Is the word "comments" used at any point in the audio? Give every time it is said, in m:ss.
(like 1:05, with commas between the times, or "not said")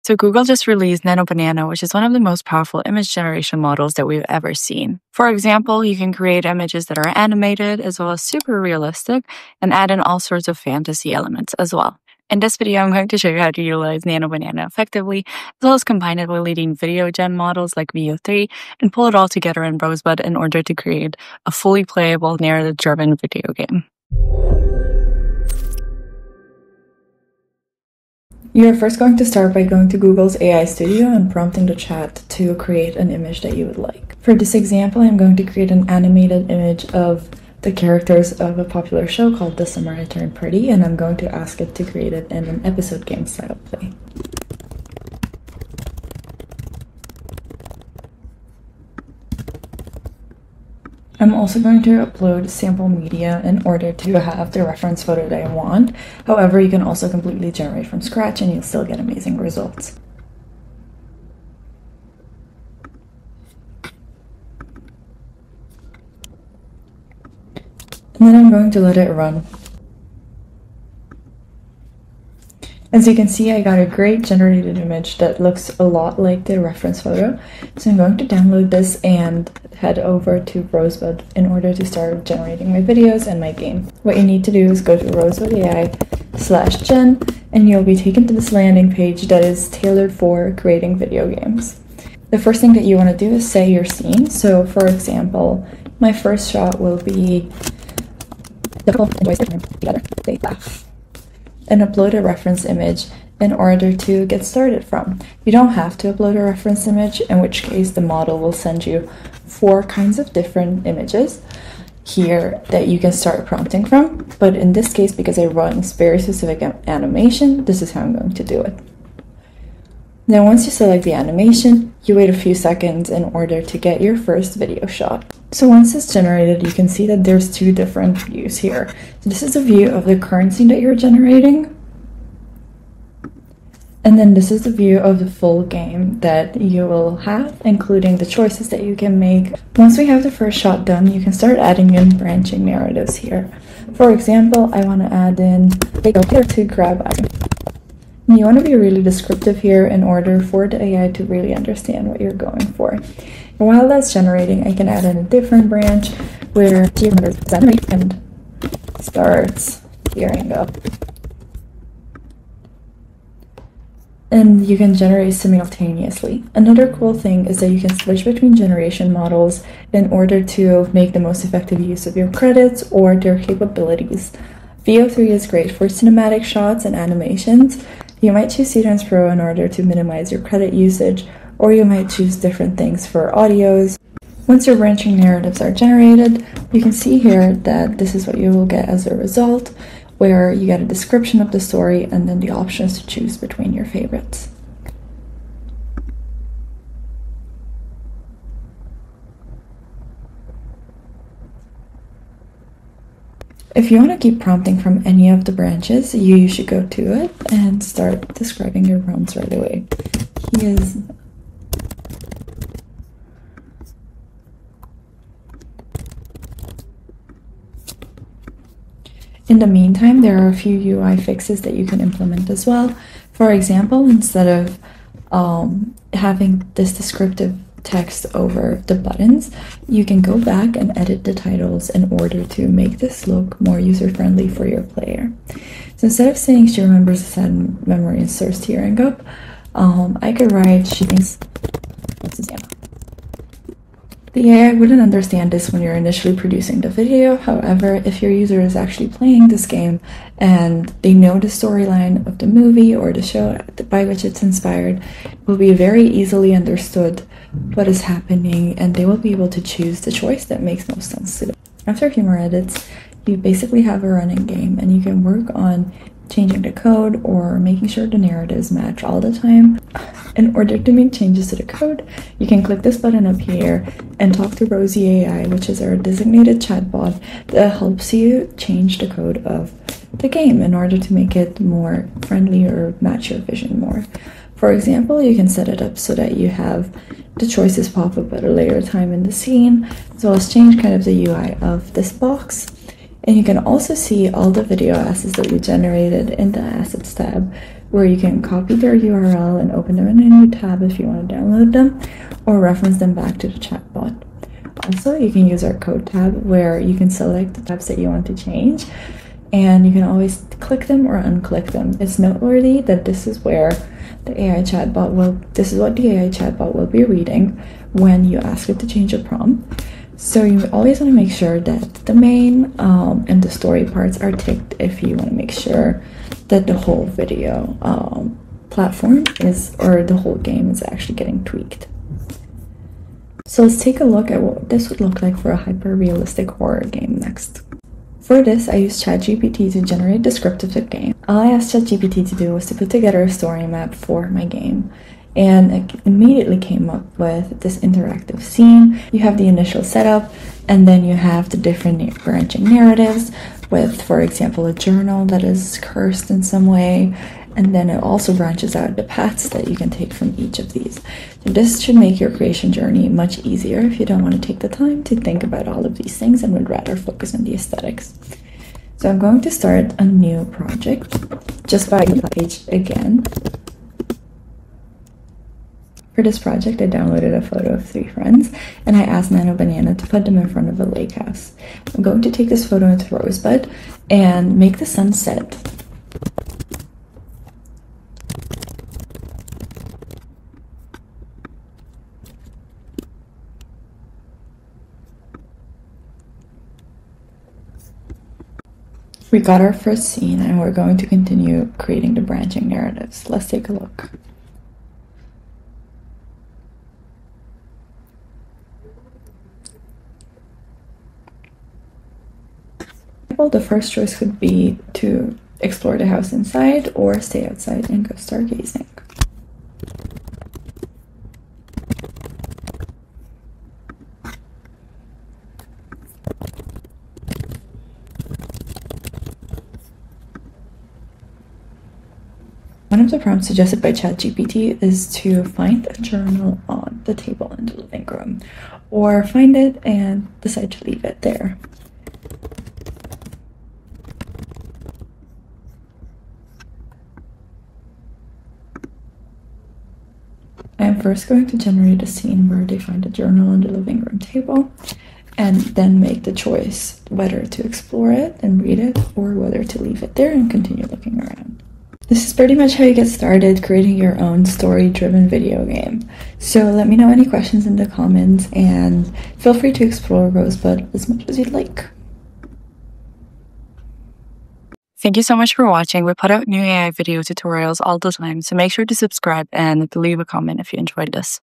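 7:47, 8:00.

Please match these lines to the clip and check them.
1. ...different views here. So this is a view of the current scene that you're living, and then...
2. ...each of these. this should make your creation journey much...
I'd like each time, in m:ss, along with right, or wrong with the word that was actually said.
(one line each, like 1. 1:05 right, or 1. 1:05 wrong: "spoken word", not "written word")
1. 2:07 wrong: "generating", not "living"
2. 6:00 right.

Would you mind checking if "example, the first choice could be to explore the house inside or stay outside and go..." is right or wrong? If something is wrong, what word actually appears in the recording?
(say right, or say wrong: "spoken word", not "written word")
right.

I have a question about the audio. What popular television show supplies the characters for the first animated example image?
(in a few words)
The Summer I Turned Pretty.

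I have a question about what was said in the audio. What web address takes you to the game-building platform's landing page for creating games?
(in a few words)
Rosebud AI slash gen.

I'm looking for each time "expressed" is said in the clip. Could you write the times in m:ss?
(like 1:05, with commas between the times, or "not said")
not said.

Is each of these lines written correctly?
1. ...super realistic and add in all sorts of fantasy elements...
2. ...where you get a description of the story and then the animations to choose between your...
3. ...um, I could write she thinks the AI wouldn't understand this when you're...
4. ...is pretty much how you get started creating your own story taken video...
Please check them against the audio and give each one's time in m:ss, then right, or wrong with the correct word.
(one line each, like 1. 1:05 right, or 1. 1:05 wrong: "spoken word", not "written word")
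1. 0:08 right
2. 3:10 wrong: "options", not "animations"
3. 3:59 right
4. 7:42 wrong: "driven", not "taken".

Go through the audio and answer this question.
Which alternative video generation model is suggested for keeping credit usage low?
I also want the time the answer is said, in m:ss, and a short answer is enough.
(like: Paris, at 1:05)
Seedance Pro, at 2:58.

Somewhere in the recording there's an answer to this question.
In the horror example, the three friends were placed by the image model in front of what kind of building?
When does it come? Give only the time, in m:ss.
6:20.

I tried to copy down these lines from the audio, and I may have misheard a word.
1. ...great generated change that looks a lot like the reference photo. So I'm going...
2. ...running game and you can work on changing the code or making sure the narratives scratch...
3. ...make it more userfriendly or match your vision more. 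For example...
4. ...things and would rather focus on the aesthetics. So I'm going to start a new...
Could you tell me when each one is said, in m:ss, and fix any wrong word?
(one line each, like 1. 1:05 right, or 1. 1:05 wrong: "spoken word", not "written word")
1. 1:13 wrong: "image", not "change"
2. 4:24 wrong: "match", not "scratch"
3. 4:41 wrong: "friendly", not "userfriendly"
4. 6:06 right.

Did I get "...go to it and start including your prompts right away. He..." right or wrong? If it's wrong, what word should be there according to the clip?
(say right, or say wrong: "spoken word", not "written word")
wrong: "describing", not "including".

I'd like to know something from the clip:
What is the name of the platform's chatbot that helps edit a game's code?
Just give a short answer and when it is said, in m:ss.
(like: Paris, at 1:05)
Rosie AI, at 4:34.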